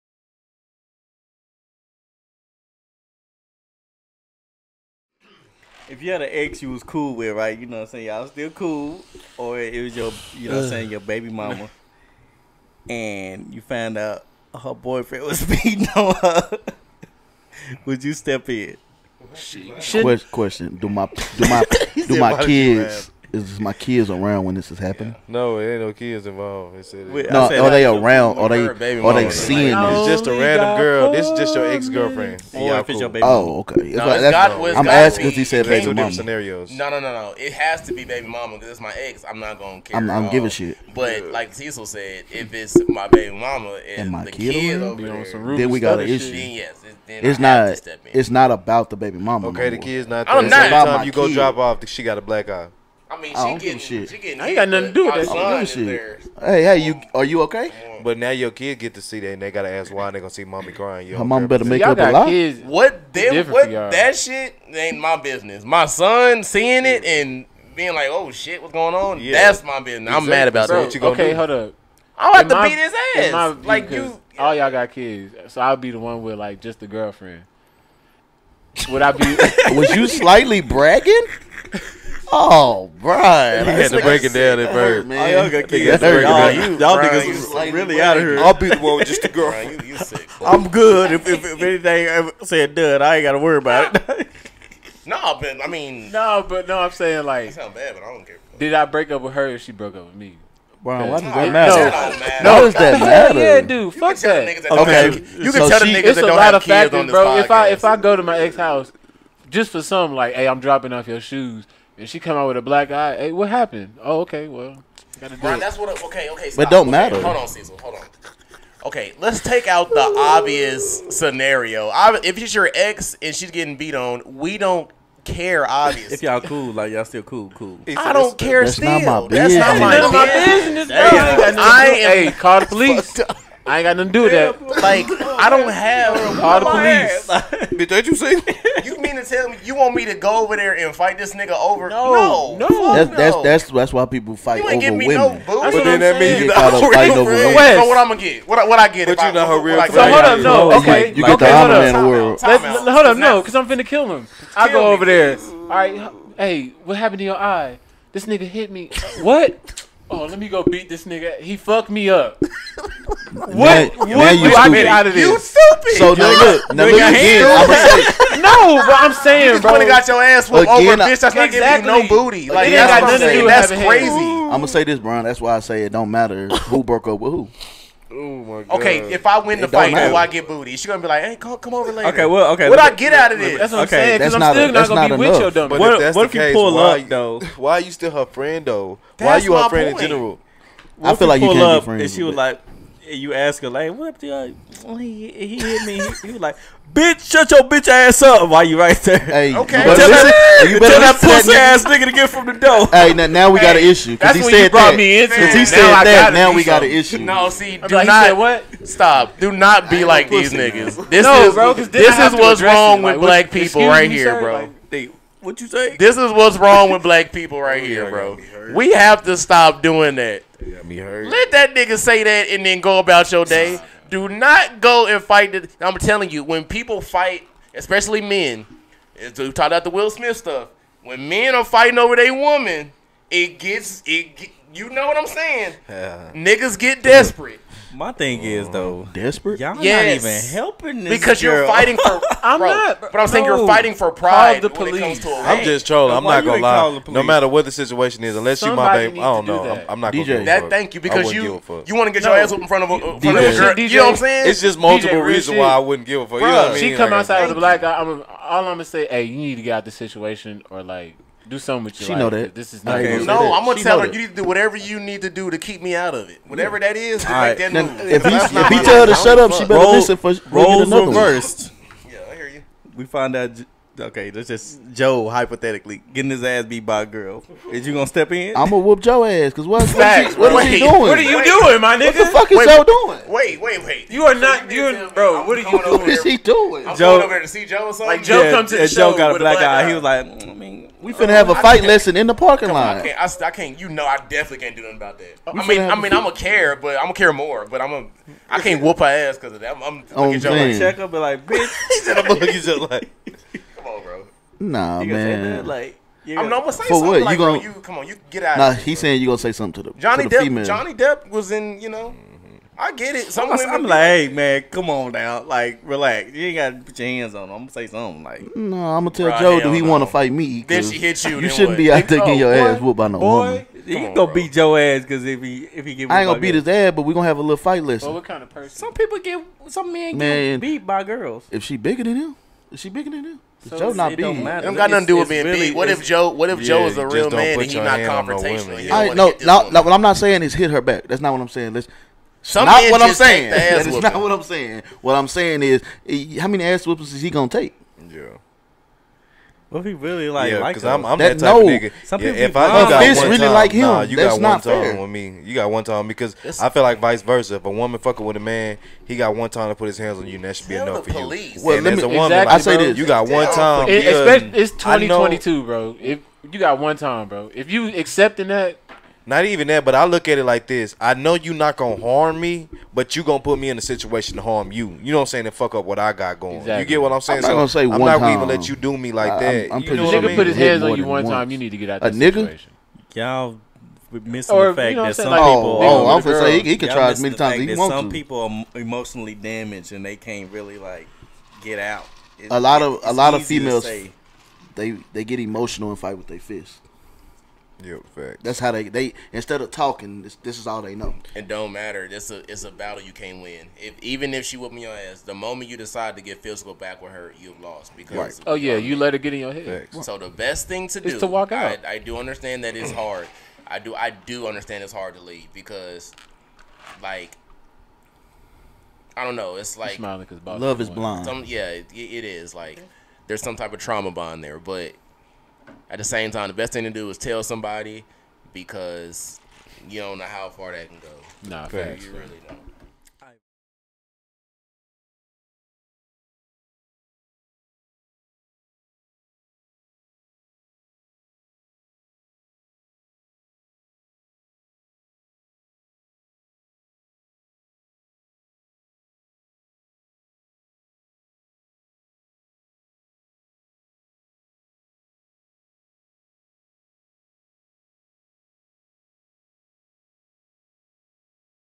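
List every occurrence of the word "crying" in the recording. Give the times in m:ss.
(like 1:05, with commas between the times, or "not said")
1:00.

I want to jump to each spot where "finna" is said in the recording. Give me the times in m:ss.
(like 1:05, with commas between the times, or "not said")
2:33, 4:51.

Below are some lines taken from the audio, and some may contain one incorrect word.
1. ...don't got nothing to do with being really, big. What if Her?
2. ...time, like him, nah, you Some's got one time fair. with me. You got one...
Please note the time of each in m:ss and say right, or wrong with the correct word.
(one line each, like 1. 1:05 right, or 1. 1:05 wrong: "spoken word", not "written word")
1. 5:34 wrong: "Joe", not "Her"
2. 5:53 wrong: "That", not "Some".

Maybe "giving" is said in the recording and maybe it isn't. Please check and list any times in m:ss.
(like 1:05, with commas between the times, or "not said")
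0:40, 2:24, 2:51.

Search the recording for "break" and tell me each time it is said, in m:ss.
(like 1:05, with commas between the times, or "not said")
1:24, 1:38.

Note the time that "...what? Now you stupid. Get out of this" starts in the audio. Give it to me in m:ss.
2:43.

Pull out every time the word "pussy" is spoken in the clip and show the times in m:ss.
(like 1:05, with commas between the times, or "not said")
3:21.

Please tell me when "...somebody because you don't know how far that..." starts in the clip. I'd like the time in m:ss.
7:07.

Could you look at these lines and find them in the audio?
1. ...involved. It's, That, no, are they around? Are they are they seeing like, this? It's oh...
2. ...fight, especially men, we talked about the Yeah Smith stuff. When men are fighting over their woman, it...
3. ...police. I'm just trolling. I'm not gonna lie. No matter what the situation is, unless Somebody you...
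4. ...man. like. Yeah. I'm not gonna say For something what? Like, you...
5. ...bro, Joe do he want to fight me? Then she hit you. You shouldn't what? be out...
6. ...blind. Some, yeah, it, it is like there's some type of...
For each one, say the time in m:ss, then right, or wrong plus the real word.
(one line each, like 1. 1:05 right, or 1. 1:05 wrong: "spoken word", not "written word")
1. 0:26 wrong: "Wait", not "That"
2. 3:47 wrong: "Will", not "Yeah"
3. 4:04 right
4. 5:05 right
5. 5:19 right
6. 7:00 right.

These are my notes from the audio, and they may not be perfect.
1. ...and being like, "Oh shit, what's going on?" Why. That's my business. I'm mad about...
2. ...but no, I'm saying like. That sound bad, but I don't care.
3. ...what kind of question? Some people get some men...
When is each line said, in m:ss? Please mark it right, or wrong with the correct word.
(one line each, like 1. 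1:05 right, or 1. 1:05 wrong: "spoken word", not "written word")
1. 1:07 wrong: "Yeah", not "Why"
2. 1:36 right
3. 5:28 wrong: "person", not "question".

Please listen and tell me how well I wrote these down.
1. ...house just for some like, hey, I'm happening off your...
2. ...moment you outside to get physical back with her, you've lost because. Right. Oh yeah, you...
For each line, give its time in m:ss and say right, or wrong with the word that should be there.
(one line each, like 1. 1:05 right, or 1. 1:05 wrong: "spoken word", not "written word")
1. 1:48 wrong: "dropping", not "happening"
2. 6:45 wrong: "decide", not "outside".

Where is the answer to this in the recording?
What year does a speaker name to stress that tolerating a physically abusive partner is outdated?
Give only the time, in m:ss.
6:04.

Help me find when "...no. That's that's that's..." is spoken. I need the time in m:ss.
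2:22.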